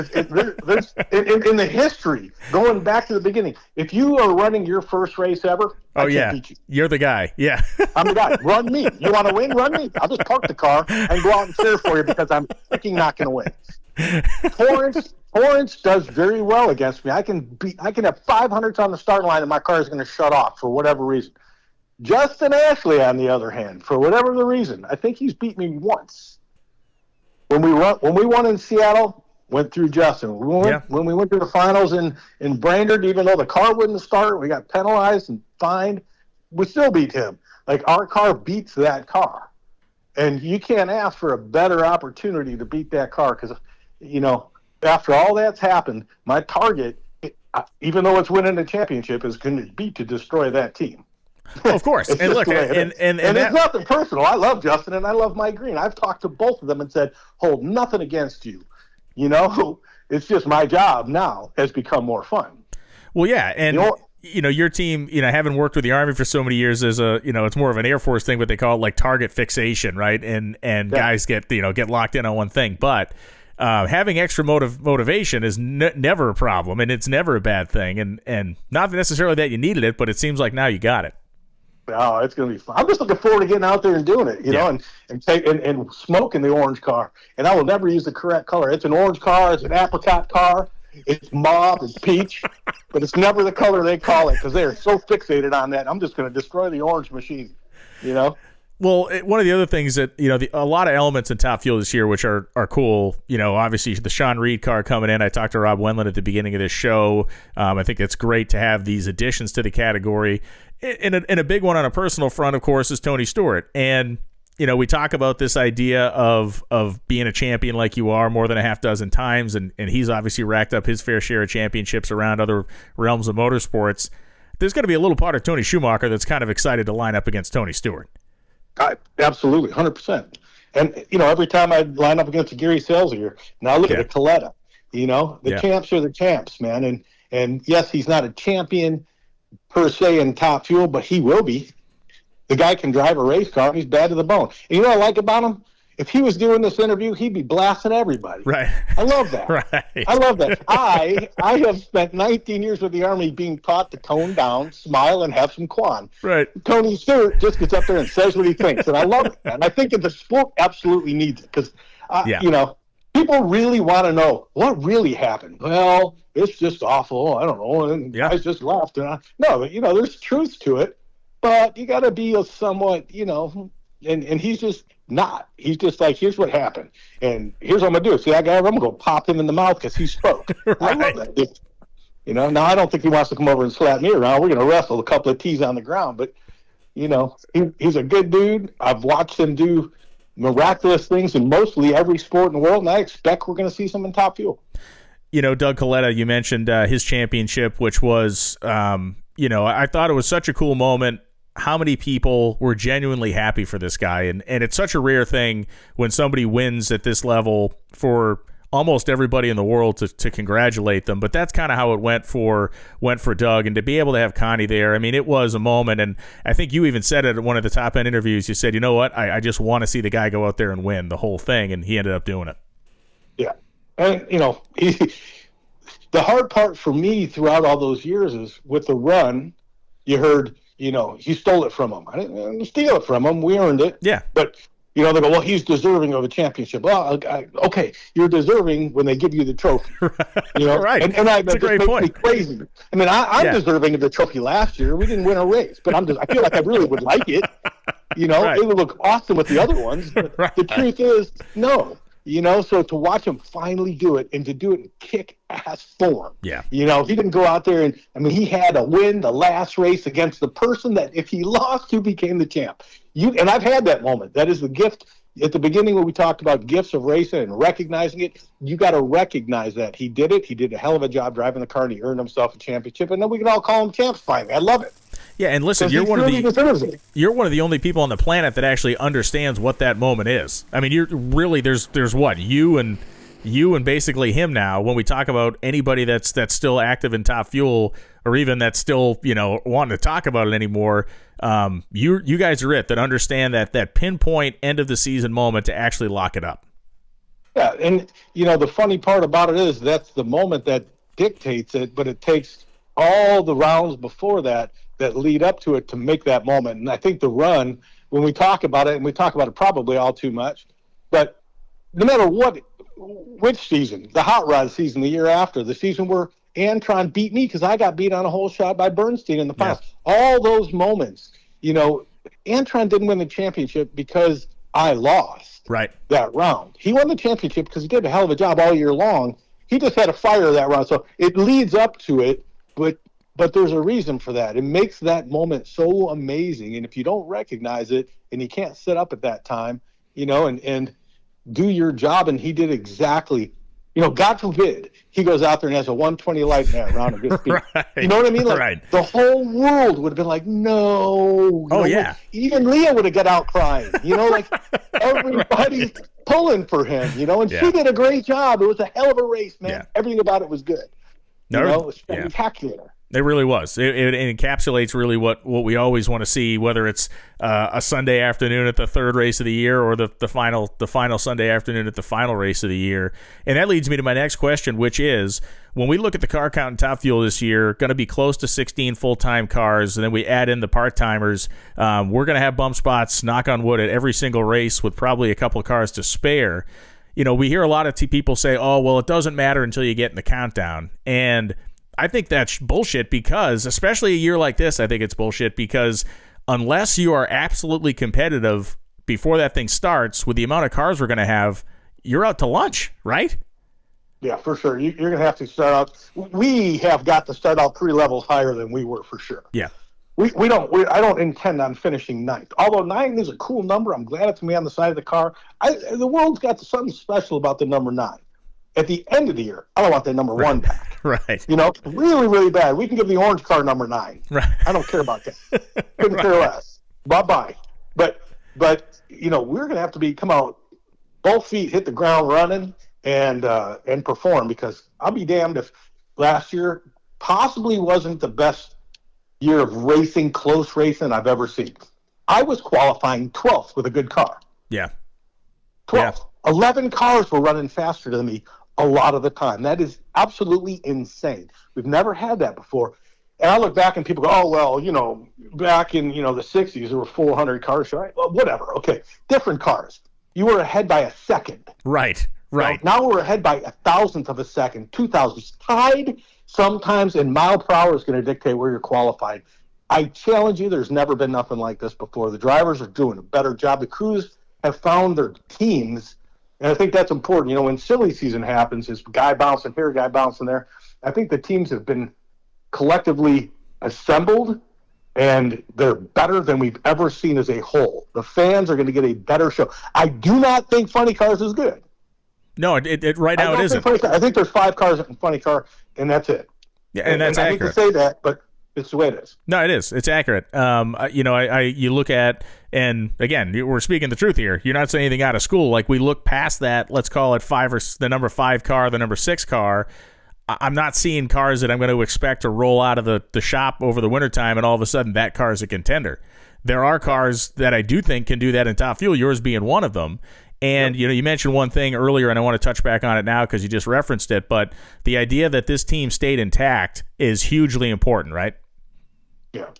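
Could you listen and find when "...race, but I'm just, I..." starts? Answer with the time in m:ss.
4:05.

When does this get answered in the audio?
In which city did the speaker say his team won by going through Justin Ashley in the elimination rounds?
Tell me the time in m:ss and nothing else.
0:28.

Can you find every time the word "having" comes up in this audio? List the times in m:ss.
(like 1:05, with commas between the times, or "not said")
1:05, 1:13.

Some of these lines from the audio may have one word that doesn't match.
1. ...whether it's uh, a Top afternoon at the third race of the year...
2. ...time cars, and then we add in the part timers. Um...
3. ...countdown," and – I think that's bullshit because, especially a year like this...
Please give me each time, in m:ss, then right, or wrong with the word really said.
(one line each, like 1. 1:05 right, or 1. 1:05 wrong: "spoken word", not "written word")
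1. 6:06 wrong: "Sunday", not "Top"
2. 6:19 right
3. 6:30 right.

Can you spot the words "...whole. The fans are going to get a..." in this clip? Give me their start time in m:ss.
8:07.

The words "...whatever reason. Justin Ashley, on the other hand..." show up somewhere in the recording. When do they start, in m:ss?
0:20.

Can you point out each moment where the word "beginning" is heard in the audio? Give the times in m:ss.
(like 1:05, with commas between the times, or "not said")
0:03, 1:46, 4:25.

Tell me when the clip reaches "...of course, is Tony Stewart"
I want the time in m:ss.
1:52.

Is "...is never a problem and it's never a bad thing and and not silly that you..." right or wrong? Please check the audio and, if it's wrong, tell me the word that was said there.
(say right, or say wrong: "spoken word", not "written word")
wrong: "necessarily", not "silly".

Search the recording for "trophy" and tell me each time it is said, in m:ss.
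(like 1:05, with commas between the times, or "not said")
3:59, 4:04.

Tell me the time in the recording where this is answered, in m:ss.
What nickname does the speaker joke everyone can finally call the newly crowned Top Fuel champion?
4:33.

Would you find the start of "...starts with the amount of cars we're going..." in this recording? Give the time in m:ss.
6:39.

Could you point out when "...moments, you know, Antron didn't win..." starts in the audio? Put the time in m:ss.
5:20.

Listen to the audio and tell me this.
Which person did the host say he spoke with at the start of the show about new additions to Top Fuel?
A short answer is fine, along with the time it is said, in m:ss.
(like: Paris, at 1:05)
Rob Wendland, at 1:45.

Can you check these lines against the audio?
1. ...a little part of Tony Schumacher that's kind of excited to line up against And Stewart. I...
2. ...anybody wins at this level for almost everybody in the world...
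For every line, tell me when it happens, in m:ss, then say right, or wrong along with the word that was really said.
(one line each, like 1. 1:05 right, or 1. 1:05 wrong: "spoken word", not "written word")
1. 2:04 wrong: "Tony", not "And"
2. 3:26 wrong: "somebody", not "anybody".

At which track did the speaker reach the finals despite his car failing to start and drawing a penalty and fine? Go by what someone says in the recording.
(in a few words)
Brainerd.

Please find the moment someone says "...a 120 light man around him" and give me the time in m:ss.
5:45.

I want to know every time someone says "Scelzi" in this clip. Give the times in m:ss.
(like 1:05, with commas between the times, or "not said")
2:12.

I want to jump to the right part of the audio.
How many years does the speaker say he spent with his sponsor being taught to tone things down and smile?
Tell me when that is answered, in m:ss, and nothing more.
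2:32.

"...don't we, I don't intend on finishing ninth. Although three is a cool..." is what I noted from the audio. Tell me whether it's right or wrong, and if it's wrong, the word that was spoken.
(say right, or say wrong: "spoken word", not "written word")
wrong: "nine", not "three".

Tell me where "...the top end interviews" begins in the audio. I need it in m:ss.
3:37.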